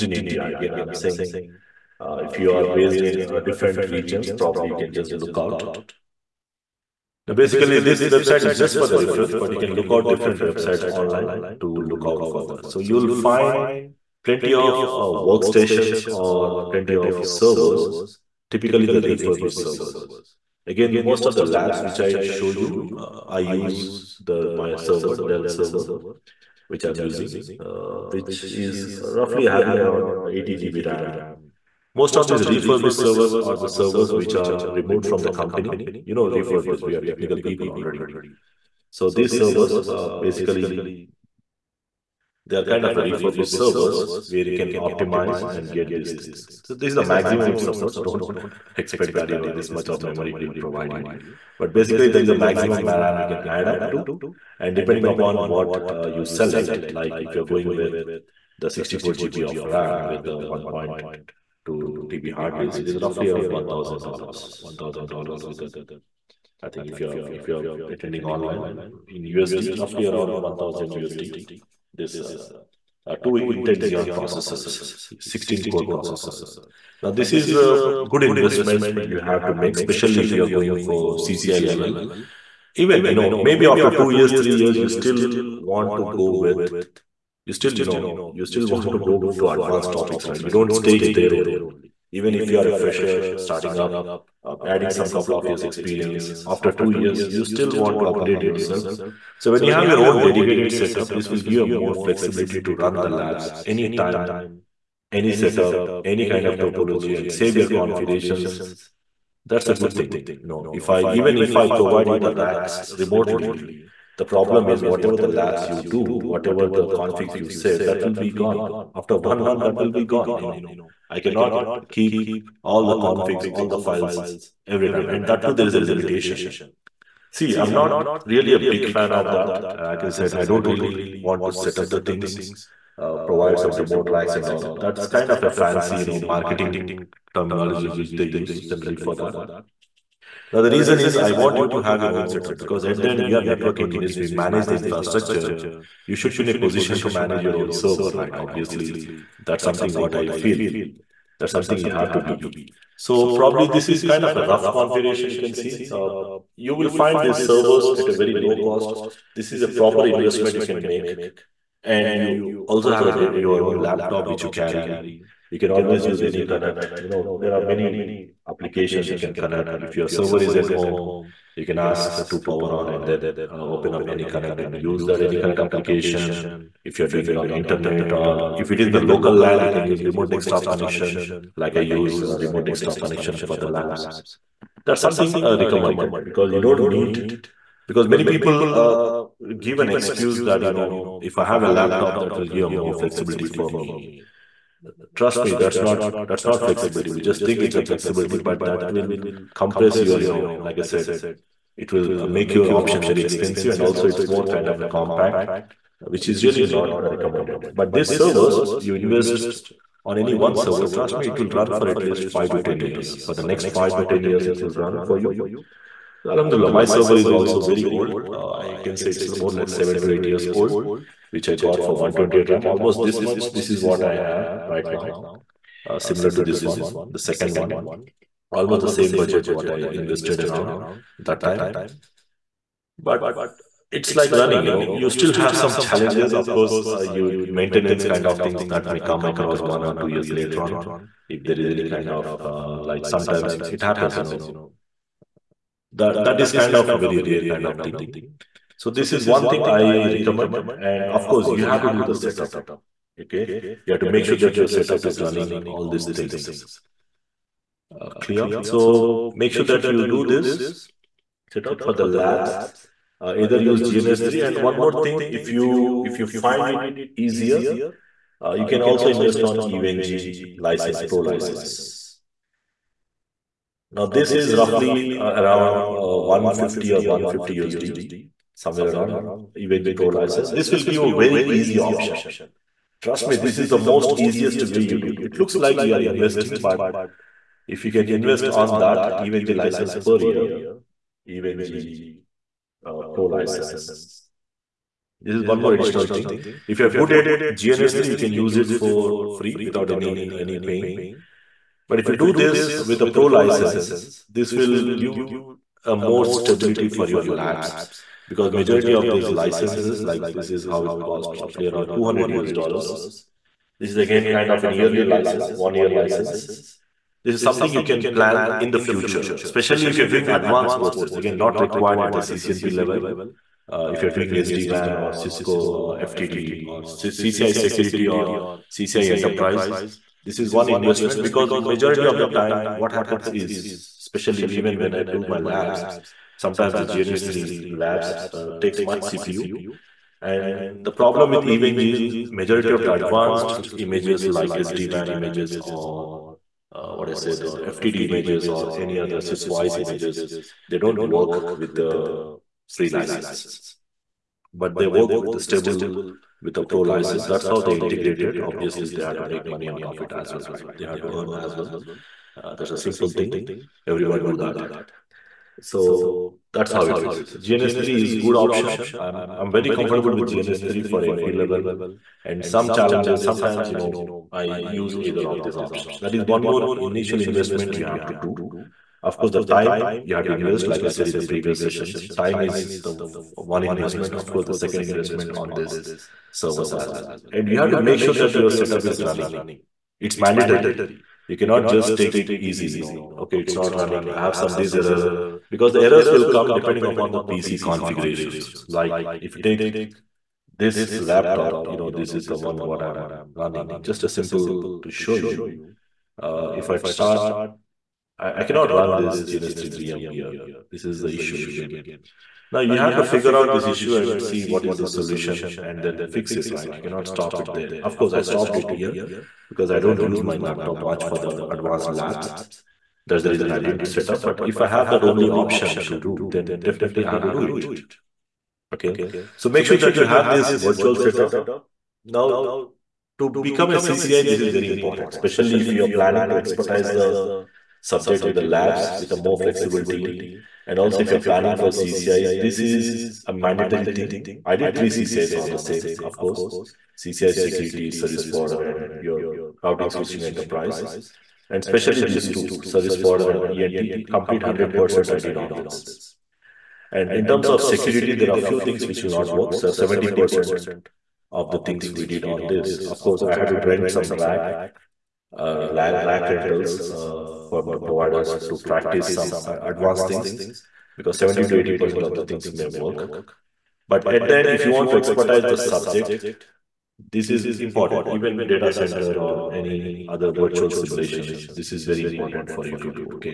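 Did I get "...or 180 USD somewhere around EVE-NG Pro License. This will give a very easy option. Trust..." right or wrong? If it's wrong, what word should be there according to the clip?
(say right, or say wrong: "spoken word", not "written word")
wrong: "150", not "180".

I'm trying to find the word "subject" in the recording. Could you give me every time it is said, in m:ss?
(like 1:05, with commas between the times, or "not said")
7:17, 7:55.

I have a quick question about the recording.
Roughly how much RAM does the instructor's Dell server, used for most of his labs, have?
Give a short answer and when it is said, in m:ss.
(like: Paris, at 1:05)
80 GB, at 0:30.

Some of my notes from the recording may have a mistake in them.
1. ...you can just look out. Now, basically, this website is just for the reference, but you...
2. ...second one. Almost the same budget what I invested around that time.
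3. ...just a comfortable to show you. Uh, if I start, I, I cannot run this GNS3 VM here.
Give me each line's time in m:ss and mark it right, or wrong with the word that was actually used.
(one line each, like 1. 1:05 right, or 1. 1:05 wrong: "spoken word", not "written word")
1. 0:04 right
2. 3:47 right
3. 6:43 wrong: "simple", not "comfortable".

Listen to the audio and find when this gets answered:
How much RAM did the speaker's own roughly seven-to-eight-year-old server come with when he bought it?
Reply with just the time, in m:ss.
3:41.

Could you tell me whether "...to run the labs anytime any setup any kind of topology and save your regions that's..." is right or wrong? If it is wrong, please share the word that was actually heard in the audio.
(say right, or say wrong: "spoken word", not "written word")
wrong: "configurations", not "regions".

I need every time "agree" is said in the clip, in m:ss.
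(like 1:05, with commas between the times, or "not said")
not said.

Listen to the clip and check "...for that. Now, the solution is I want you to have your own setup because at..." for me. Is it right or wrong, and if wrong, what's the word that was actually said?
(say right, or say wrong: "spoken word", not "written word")
wrong: "reason", not "solution".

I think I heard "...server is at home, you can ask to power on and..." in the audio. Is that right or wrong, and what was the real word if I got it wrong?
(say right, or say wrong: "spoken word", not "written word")
right.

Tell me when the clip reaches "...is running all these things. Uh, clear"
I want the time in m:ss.
4:15.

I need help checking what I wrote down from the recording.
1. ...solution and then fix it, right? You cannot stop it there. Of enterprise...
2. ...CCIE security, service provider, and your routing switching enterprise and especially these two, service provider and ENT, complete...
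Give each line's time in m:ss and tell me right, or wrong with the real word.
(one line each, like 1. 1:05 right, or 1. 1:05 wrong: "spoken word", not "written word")
1. 6:54 wrong: "course", not "enterprise"
2. 7:26 right.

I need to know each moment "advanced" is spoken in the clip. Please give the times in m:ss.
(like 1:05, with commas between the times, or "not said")
1:29, 5:20, 5:42, 7:01, 7:49.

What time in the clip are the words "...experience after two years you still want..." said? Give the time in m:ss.
1:35.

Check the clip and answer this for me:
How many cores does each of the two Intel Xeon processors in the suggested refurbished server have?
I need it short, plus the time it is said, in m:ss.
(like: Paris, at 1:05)
16, at 1:15.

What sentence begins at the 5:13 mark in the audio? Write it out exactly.
This is again kind of an yearly license, one year license.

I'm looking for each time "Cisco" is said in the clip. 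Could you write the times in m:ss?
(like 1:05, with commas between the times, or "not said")
5:25, 5:49.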